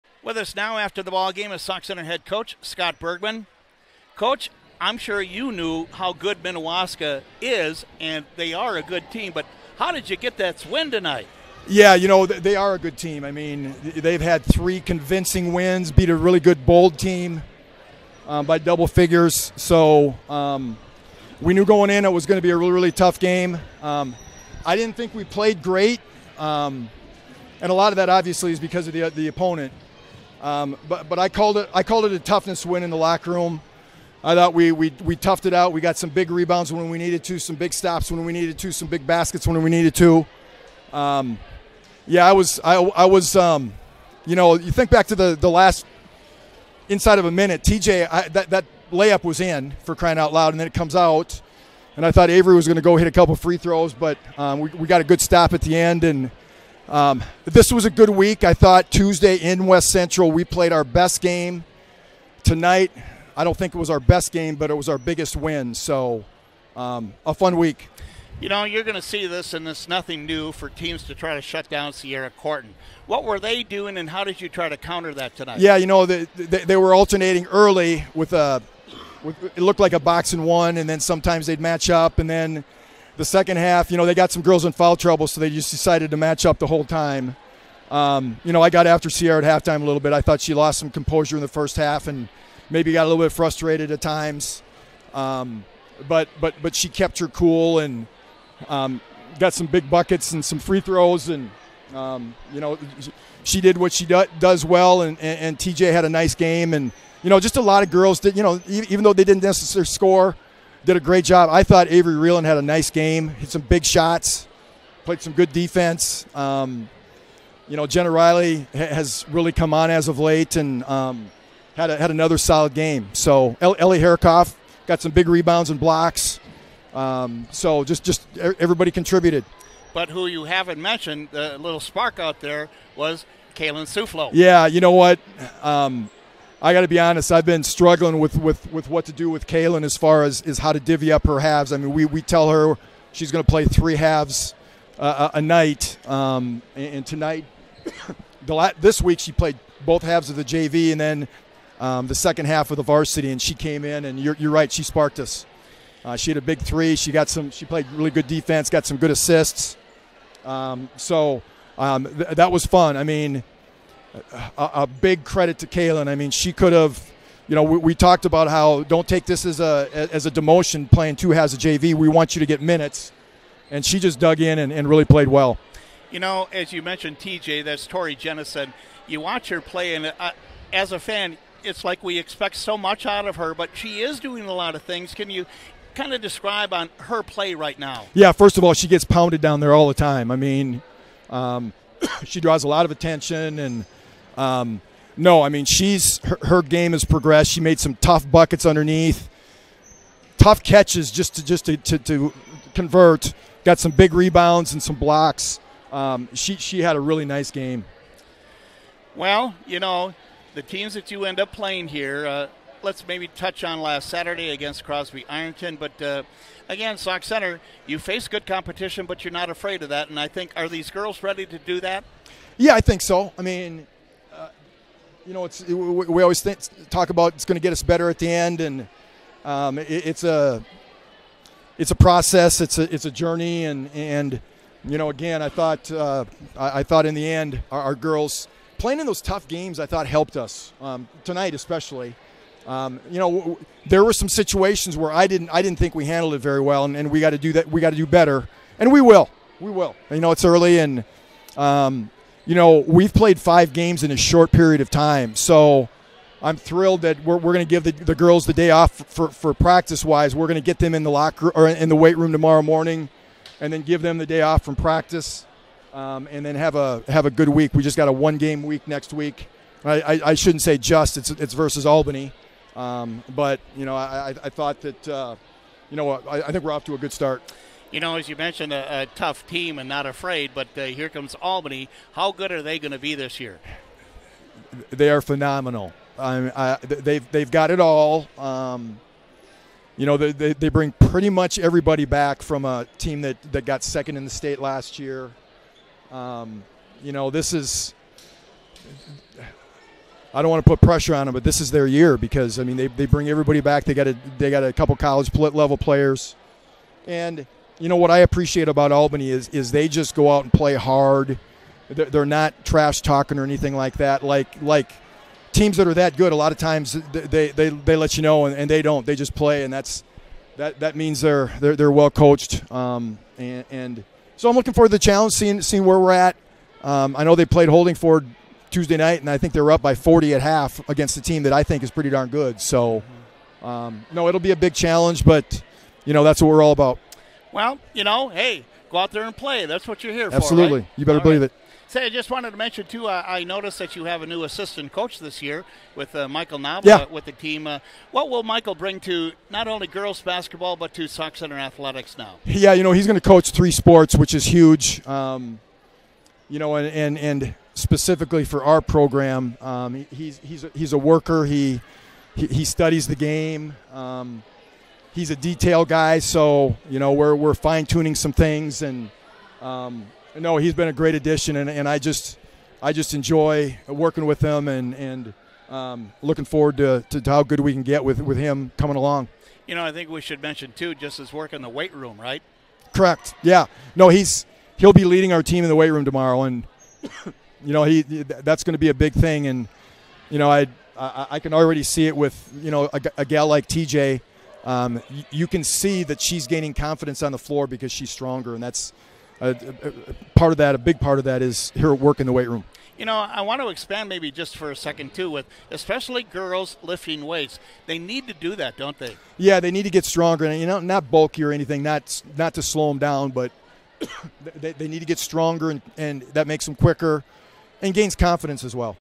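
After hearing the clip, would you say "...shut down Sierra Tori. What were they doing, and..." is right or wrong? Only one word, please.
wrong.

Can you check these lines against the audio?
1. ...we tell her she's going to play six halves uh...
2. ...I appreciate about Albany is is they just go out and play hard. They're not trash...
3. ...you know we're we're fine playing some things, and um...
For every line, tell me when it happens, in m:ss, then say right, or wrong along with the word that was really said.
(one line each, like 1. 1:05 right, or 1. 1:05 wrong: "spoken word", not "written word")
1. 2:22 wrong: "three", not "six"
2. 5:08 right
3. 6:06 wrong: "tuning", not "playing".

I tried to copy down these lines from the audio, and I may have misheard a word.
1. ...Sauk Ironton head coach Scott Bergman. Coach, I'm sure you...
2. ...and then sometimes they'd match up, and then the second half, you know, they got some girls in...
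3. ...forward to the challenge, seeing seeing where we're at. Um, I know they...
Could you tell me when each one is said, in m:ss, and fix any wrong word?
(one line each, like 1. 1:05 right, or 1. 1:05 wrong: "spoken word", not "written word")
1. 0:01 wrong: "Centre", not "Ironton"
2. 1:20 right
3. 5:24 right.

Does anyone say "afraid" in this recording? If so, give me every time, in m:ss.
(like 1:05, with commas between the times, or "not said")
3:39, 4:40.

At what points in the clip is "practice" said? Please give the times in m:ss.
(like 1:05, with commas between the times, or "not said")
4:19, 4:24.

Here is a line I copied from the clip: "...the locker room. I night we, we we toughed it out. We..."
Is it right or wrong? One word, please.
wrong.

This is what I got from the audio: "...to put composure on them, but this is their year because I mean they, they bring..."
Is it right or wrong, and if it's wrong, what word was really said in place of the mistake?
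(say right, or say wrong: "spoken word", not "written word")
wrong: "pressure", not "composure".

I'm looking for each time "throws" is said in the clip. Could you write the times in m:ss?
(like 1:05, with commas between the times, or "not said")
0:53, 1:40.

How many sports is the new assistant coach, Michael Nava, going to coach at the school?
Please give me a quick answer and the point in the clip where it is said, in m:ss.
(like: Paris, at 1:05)
3, at 5:53.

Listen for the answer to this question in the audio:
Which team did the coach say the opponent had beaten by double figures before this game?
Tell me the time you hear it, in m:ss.
0:16.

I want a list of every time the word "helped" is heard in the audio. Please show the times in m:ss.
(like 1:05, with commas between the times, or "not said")
4:00.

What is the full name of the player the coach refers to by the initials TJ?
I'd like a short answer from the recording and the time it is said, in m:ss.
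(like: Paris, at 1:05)
Tori Jennison, at 2:57.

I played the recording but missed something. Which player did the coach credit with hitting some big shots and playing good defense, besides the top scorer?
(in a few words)
Avery Reeland.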